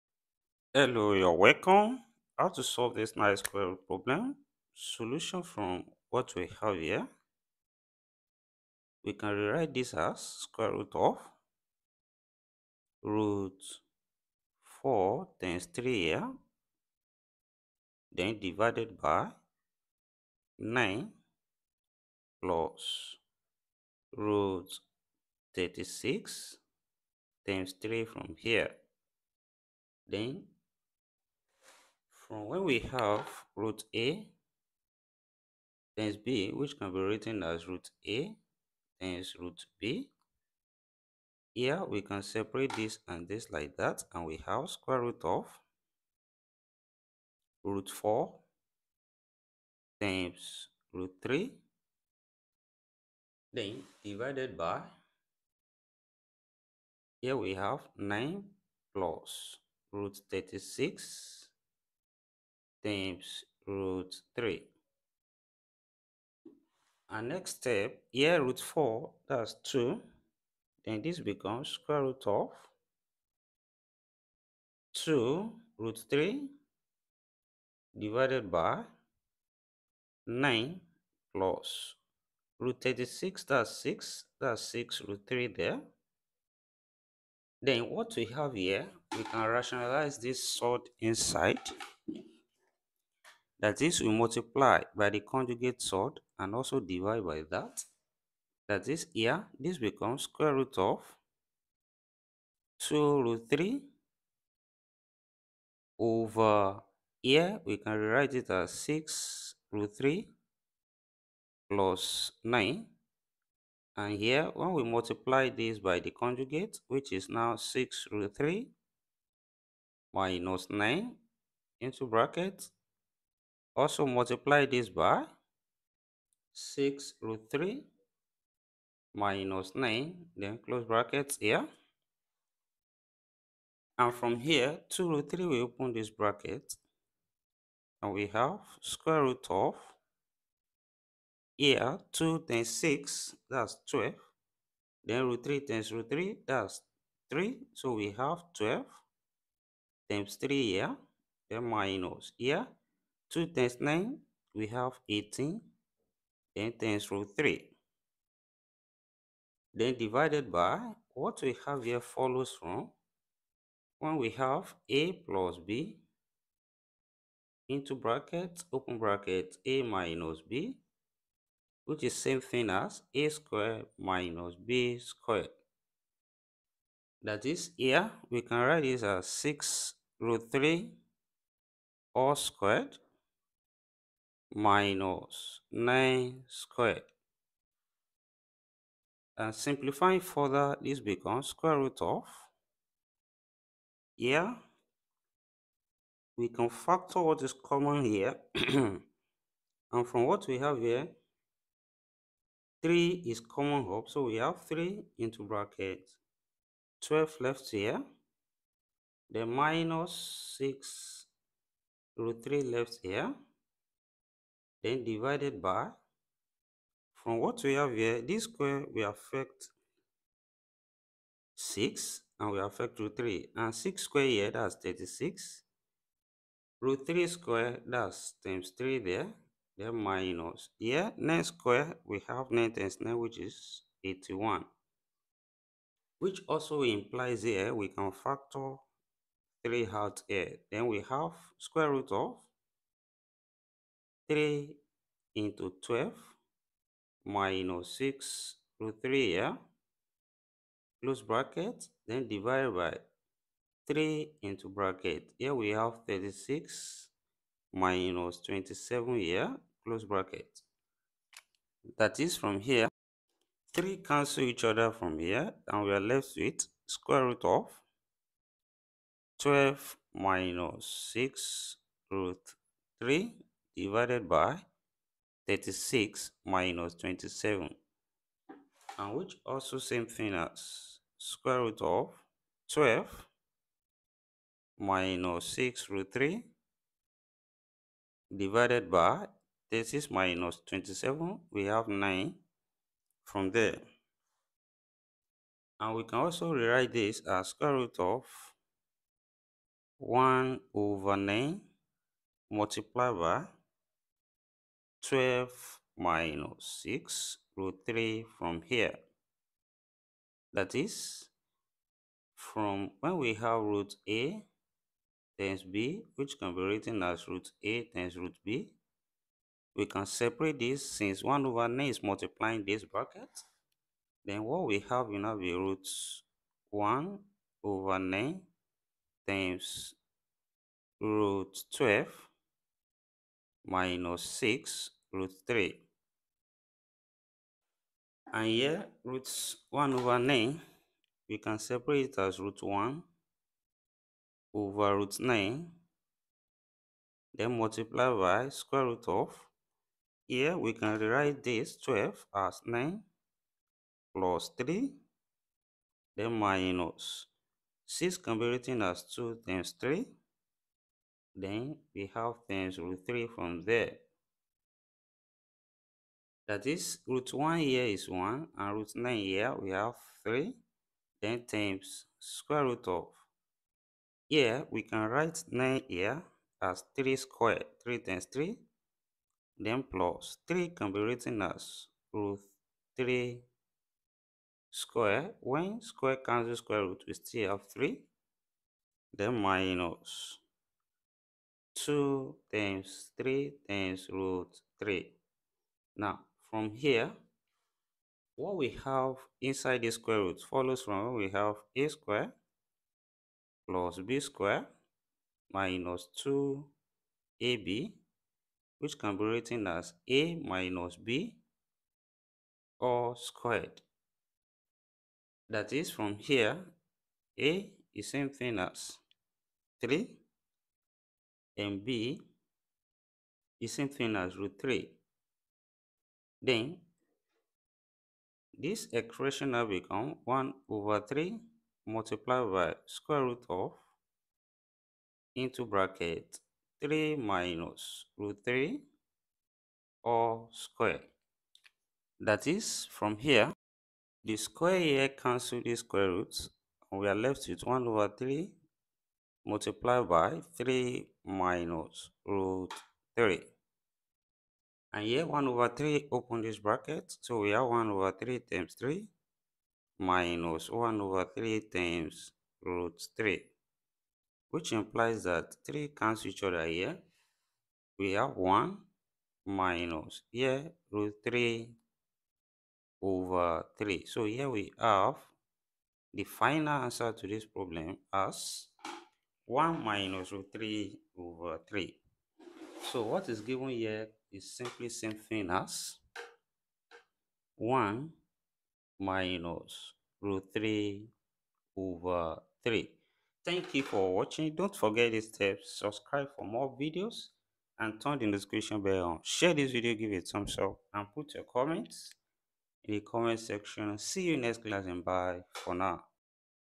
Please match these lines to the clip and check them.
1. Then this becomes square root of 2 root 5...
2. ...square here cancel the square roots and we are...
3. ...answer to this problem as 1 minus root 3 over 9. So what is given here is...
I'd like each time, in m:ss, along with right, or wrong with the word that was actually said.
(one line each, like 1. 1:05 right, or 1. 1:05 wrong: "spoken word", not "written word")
1. 1:10 wrong: "3", not "5"
2. 7:24 right
3. 7:56 wrong: "3", not "9".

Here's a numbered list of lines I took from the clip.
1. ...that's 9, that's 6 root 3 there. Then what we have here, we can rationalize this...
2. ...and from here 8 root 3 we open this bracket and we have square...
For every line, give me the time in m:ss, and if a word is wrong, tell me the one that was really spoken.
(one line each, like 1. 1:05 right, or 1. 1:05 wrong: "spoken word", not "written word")
1. 1:23 wrong: "6", not "9"
2. 2:13 wrong: "2", not "8".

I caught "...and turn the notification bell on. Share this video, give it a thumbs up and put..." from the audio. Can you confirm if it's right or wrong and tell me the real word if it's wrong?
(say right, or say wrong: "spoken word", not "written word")
right.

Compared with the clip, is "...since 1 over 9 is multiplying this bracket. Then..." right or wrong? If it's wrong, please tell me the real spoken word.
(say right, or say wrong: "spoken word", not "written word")
right.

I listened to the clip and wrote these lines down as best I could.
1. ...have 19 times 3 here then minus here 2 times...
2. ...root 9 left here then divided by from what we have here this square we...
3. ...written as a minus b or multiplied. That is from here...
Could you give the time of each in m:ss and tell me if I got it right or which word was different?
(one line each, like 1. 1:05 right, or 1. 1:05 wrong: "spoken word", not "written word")
1. 2:28 wrong: "12", not "19"
2. 3:32 wrong: "3", not "9"
3. 6:49 wrong: "squared", not "multiplied".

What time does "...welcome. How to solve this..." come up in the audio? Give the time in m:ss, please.
0:01.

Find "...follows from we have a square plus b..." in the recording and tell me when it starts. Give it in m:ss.
6:40.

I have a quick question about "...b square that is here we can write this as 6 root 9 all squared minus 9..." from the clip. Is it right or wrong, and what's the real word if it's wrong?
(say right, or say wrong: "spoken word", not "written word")
wrong: "3", not "9".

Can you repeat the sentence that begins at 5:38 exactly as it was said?
And here, root 1 over 9, we can separate it as root 1 over root 9.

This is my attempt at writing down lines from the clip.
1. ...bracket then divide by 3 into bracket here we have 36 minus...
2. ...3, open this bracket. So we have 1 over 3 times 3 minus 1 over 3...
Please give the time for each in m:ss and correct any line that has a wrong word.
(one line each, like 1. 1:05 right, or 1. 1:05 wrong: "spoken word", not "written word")
1. 4:11 right
2. 7:35 right.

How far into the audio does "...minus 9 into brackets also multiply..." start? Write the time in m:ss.
2:00.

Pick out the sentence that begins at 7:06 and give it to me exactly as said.
Then this equation now become 1 over 3 multiplied by square root of into bracket 3 minus root 3 or square.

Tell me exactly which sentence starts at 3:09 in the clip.
And uh, simplifying further, this becomes square root of.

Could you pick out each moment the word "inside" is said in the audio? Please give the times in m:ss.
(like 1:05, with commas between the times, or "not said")
1:30, 6:39.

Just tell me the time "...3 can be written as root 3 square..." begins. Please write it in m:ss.
6:20.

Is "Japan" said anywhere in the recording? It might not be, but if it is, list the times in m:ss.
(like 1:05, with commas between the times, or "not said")
not said.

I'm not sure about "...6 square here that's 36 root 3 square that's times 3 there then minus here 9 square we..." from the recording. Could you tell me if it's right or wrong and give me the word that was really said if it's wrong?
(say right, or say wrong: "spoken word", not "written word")
right.